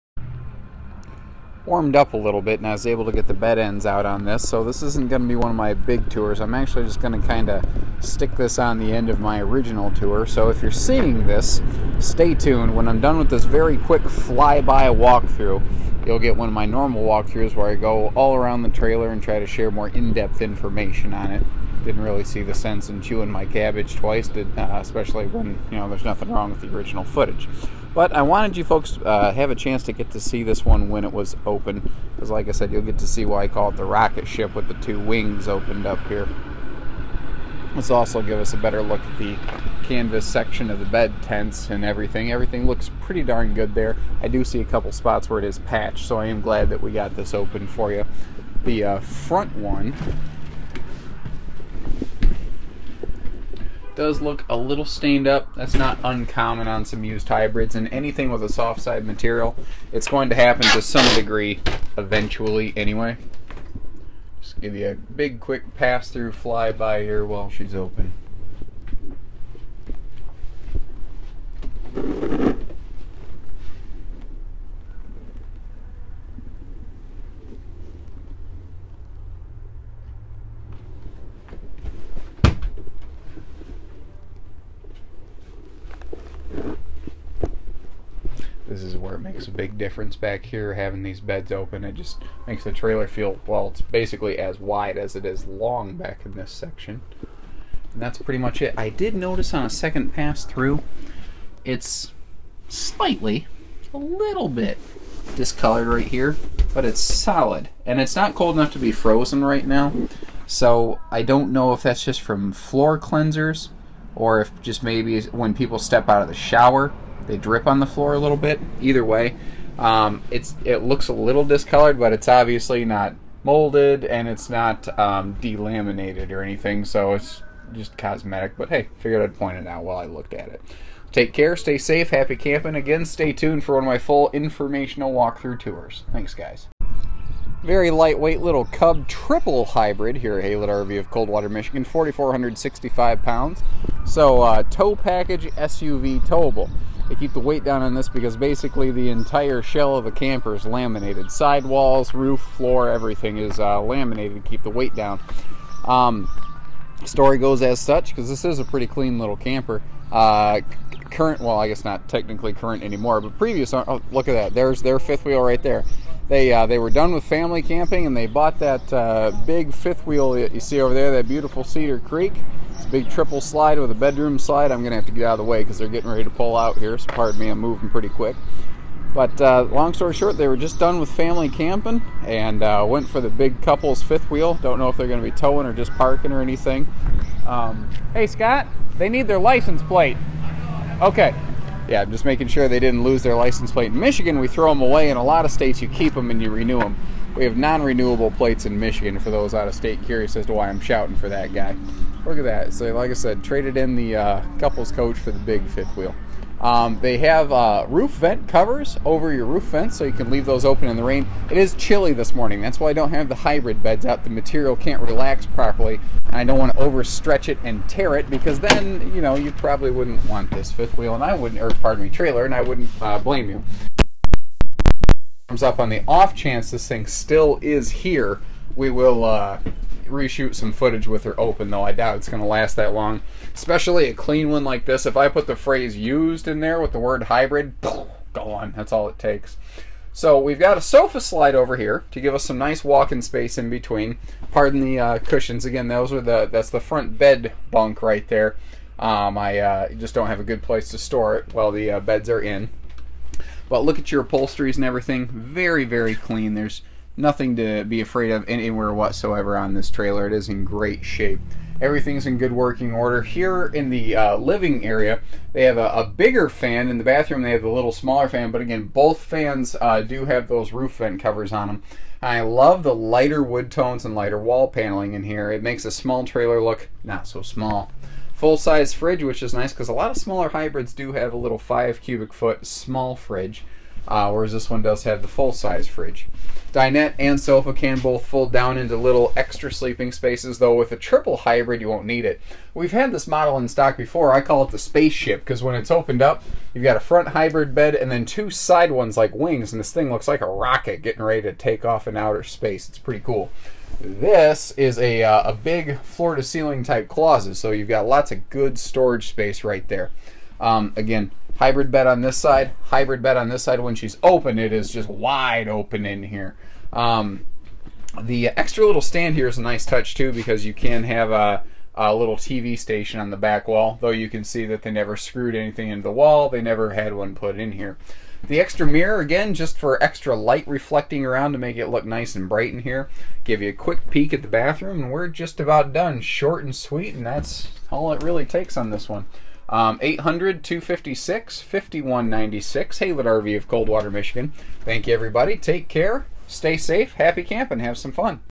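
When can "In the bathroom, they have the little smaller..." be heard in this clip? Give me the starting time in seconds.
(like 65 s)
266 s.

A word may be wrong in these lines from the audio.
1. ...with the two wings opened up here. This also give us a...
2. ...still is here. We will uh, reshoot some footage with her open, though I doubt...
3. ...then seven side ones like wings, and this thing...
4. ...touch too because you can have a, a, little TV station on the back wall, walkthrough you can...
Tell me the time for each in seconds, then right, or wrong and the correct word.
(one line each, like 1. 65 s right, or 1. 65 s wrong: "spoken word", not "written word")
1. 34 s right
2. 227 s right
3. 298 s wrong: "two", not "seven"
4. 319 s wrong: "though", not "walkthrough".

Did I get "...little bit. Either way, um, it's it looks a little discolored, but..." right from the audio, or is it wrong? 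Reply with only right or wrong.
right.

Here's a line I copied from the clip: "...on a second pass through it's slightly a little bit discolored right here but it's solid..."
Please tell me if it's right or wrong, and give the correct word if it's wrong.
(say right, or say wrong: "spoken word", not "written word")
right.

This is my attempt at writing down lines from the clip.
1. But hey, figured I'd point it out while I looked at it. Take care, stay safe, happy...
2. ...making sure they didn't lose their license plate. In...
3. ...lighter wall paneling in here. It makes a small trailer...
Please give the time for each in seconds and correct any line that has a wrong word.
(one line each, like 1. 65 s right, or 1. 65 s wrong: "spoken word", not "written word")
1. 128 s right
2. 192 s right
3. 274 s right.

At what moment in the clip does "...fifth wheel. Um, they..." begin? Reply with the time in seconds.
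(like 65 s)
205 s.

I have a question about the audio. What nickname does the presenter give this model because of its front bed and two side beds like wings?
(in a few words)
The spaceship.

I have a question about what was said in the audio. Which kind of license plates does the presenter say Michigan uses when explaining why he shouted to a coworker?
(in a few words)
Non renewable plates.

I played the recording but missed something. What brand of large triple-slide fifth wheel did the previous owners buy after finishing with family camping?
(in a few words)
Cedar Creek.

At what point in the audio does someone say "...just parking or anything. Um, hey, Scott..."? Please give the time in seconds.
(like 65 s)
185 s.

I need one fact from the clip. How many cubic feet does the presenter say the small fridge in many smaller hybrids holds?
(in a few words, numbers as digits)
5 cubic feet.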